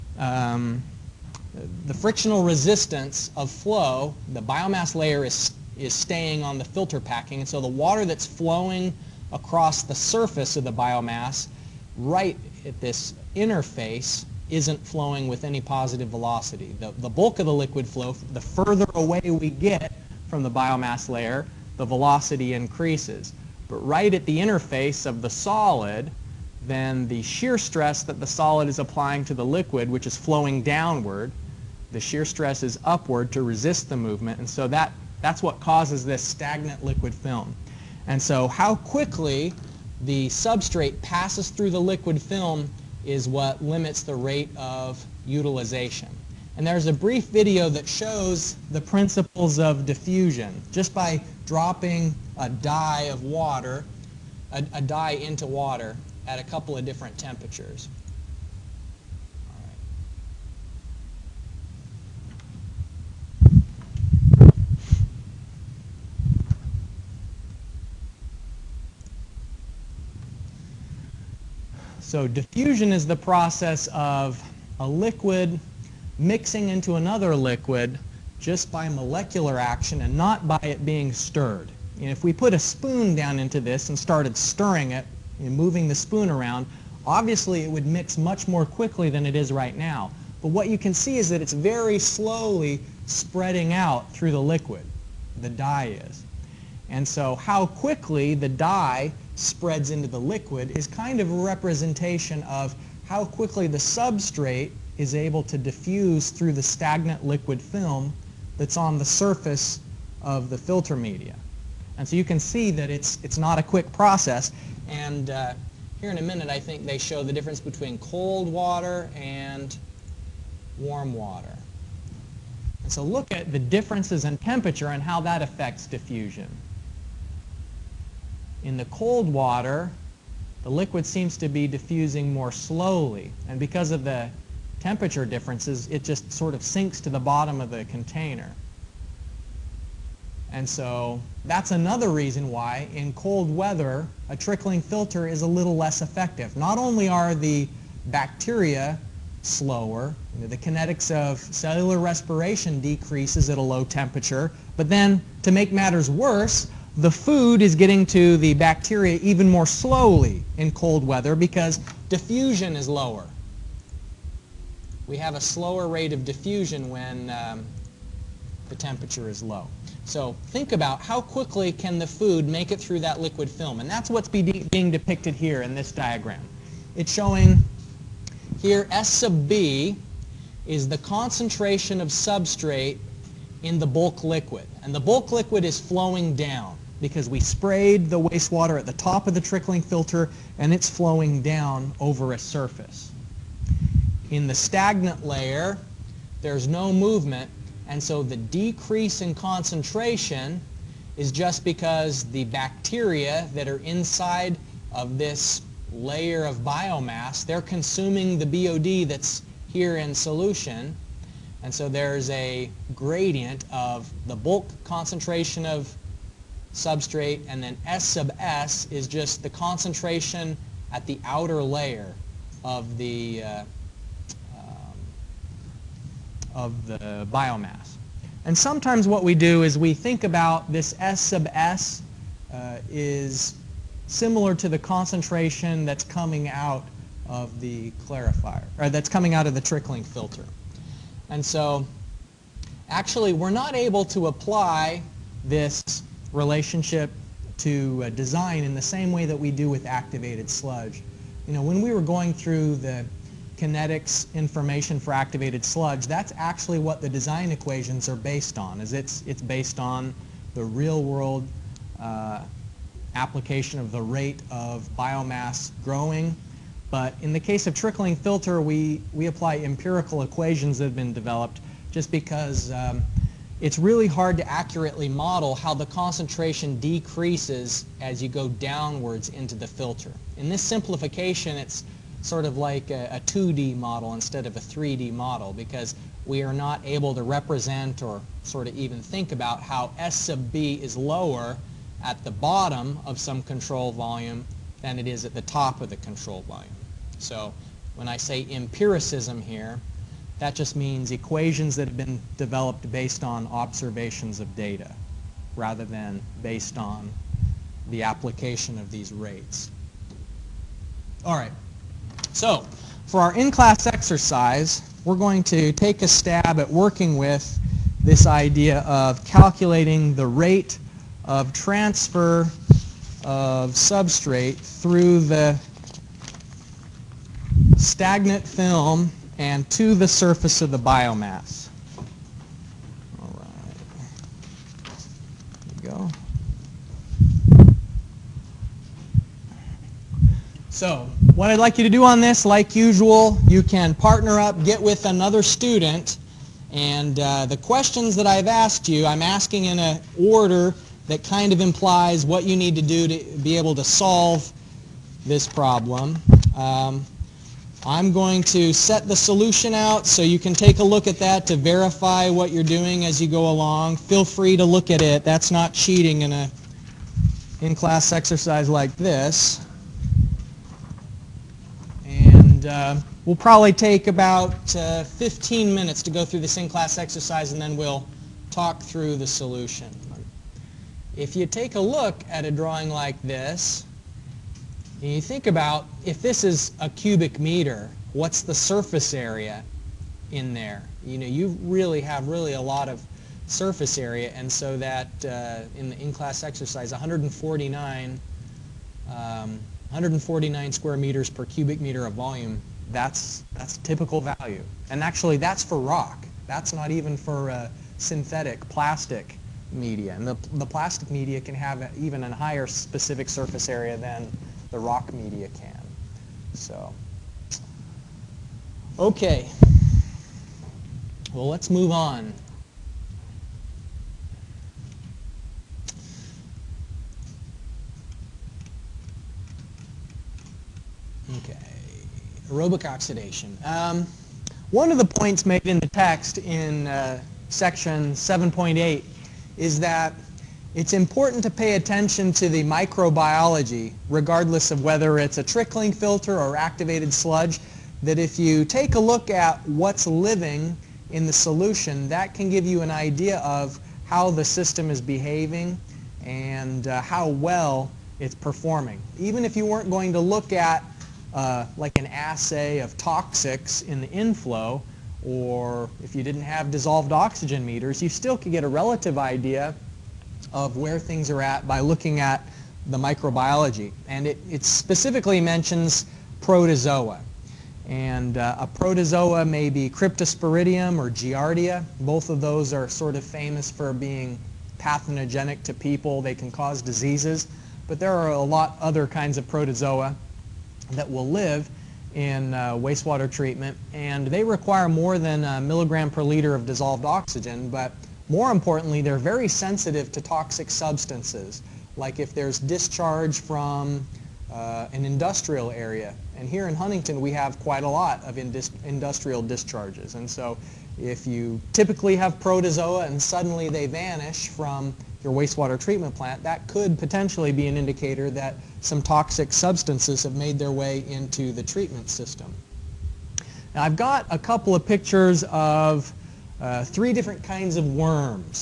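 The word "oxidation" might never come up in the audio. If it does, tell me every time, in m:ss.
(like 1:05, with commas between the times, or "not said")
7:12.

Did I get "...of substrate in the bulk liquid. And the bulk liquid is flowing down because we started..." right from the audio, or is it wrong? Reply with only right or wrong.
wrong.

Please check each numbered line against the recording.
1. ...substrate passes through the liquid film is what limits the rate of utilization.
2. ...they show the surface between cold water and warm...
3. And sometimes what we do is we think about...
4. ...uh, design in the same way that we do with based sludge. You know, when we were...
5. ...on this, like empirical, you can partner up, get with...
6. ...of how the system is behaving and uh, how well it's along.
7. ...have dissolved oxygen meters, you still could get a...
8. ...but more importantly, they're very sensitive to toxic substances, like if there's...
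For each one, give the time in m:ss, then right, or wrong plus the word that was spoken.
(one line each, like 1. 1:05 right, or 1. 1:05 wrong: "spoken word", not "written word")
1. 0:40 right
2. 1:56 wrong: "difference", not "surface"
3. 3:48 right
4. 4:08 wrong: "activated", not "based"
5. 5:42 wrong: "usual", not "empirical"
6. 7:33 wrong: "performing", not "along"
7. 7:46 right
8. 8:17 right.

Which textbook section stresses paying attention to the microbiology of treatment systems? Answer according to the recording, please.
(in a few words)
7.8.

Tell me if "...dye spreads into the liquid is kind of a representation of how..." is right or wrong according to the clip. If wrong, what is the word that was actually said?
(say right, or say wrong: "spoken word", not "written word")
right.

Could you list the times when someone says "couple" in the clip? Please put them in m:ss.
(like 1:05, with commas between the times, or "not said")
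0:56, 8:44.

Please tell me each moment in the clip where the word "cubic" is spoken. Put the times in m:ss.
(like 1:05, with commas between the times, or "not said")
6:26, 6:41.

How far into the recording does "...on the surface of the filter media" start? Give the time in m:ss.
1:48.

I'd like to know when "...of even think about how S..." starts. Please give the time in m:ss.
4:48.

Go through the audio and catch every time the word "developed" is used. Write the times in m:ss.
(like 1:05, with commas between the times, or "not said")
4:31, 5:02.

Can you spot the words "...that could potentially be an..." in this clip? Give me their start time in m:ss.
8:36.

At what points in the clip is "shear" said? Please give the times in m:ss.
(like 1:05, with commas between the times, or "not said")
0:27, 0:32.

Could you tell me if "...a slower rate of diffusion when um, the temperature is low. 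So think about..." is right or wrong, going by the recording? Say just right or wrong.
right.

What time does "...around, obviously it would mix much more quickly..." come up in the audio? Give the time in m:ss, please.
1:26.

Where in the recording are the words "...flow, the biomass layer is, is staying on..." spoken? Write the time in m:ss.
0:03.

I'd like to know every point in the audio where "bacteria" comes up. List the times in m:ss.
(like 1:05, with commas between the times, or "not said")
2:28, 2:38, 3:22.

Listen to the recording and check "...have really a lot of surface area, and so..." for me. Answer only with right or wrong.
right.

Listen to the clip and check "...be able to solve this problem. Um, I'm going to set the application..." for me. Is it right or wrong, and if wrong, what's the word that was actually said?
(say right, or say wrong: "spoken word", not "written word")
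wrong: "solution", not "application".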